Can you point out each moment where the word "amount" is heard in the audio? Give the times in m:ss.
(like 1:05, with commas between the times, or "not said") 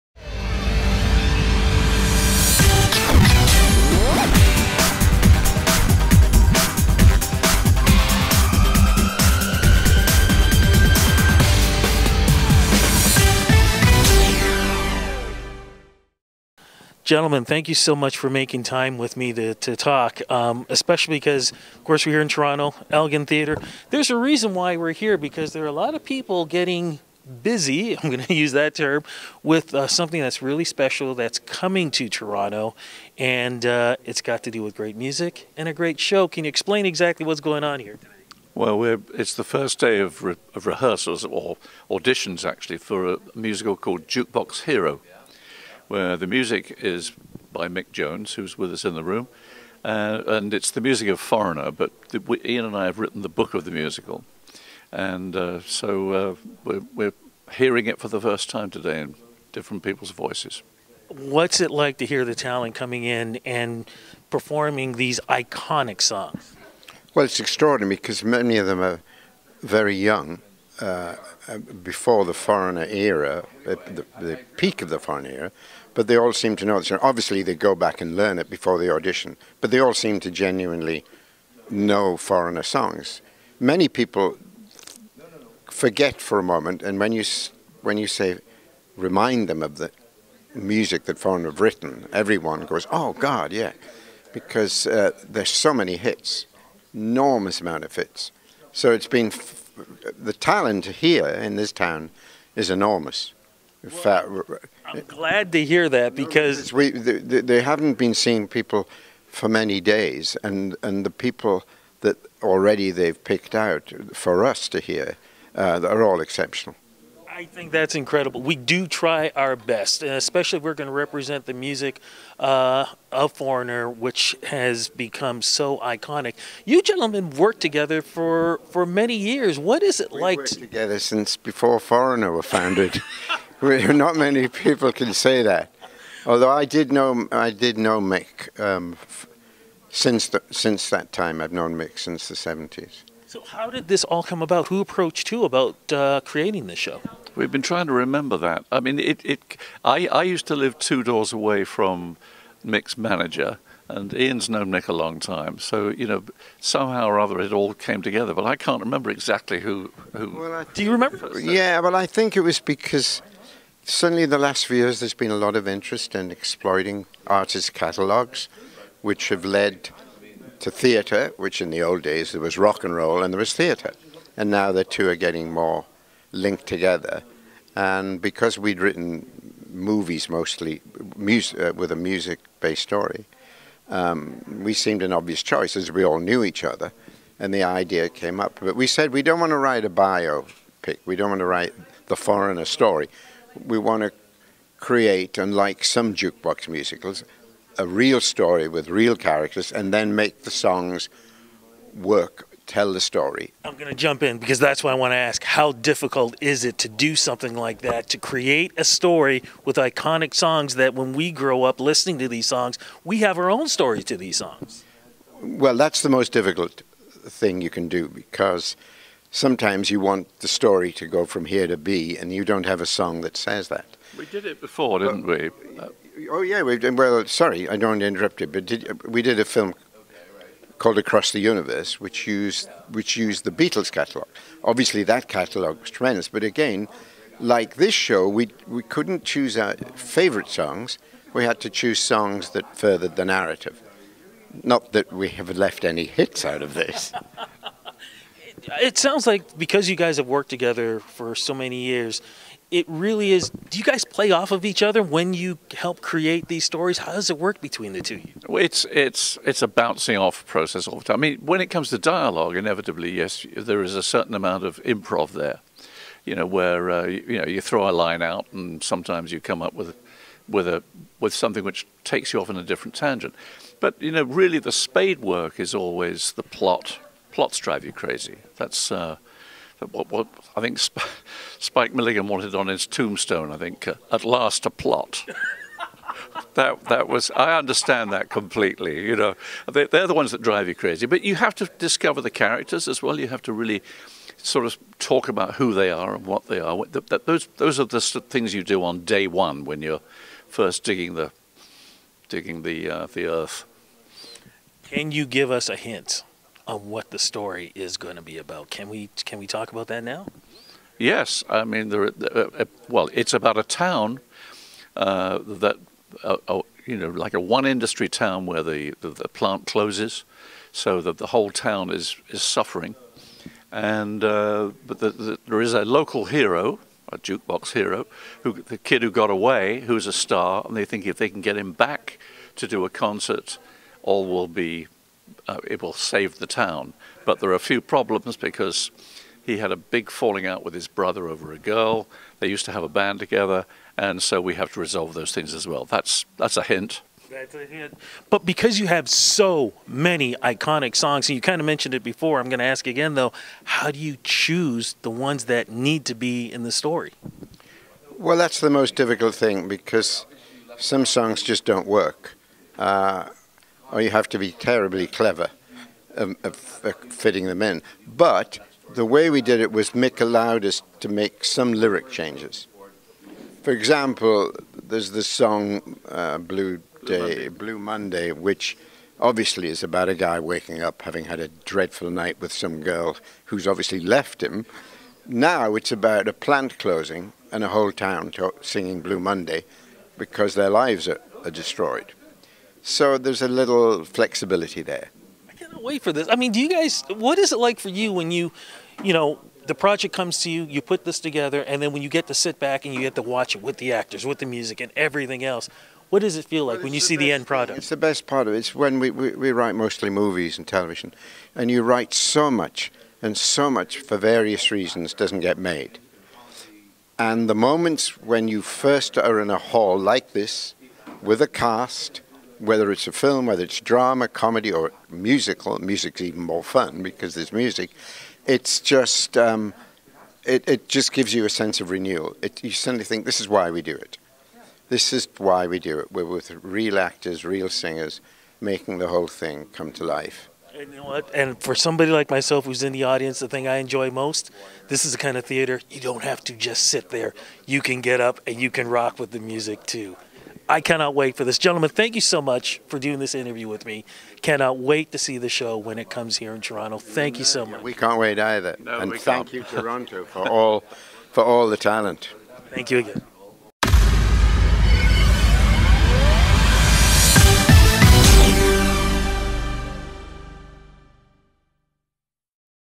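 1:37, 4:24.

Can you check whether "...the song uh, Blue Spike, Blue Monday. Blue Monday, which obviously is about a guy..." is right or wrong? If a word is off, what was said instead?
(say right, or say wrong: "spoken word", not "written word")
wrong: "Day", not "Spike".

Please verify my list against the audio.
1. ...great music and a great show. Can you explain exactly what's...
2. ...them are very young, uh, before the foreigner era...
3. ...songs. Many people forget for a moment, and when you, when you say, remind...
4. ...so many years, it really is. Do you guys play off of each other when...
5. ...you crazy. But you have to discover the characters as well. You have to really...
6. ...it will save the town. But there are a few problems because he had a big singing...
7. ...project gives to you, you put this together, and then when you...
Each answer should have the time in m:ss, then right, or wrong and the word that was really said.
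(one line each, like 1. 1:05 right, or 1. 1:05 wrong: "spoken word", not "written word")
1. 0:34 right
2. 1:08 right
3. 1:22 right
4. 4:11 right
5. 4:50 right
6. 5:35 wrong: "falling", not "singing"
7. 6:39 wrong: "comes", not "gives".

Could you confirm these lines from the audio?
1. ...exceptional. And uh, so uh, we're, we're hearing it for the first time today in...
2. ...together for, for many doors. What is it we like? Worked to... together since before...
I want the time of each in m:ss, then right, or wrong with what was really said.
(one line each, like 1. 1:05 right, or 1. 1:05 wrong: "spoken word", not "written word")
1. 0:53 wrong: "musical", not "exceptional"
2. 2:07 wrong: "years", not "doors".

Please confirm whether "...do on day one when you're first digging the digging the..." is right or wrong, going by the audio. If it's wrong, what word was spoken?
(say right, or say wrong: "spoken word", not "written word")
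right.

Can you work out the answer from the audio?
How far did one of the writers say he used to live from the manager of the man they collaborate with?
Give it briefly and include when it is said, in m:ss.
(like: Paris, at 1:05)
Two doors away, at 2:30.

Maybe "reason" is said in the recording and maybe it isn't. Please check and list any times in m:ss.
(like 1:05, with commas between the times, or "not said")
0:24, 6:54.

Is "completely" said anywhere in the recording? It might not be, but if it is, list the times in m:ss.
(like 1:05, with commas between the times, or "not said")
4:48.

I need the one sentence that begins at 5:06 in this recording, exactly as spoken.
what the story is going to be about.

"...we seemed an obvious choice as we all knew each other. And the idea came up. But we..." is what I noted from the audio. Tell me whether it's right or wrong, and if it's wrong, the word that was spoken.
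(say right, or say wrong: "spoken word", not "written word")
right.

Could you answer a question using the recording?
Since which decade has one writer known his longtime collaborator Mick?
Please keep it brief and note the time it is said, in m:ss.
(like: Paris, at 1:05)
The seventies, at 2:22.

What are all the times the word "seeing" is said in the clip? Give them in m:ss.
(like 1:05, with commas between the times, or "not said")
1:48.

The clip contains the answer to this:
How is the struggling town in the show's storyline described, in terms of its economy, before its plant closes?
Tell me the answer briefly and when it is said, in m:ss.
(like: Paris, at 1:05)
One industry town, at 5:17.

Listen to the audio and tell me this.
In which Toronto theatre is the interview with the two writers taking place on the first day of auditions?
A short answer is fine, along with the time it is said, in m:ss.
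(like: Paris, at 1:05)
Elgin Theatre, at 0:22.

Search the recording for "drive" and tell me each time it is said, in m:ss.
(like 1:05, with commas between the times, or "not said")
4:37, 4:50.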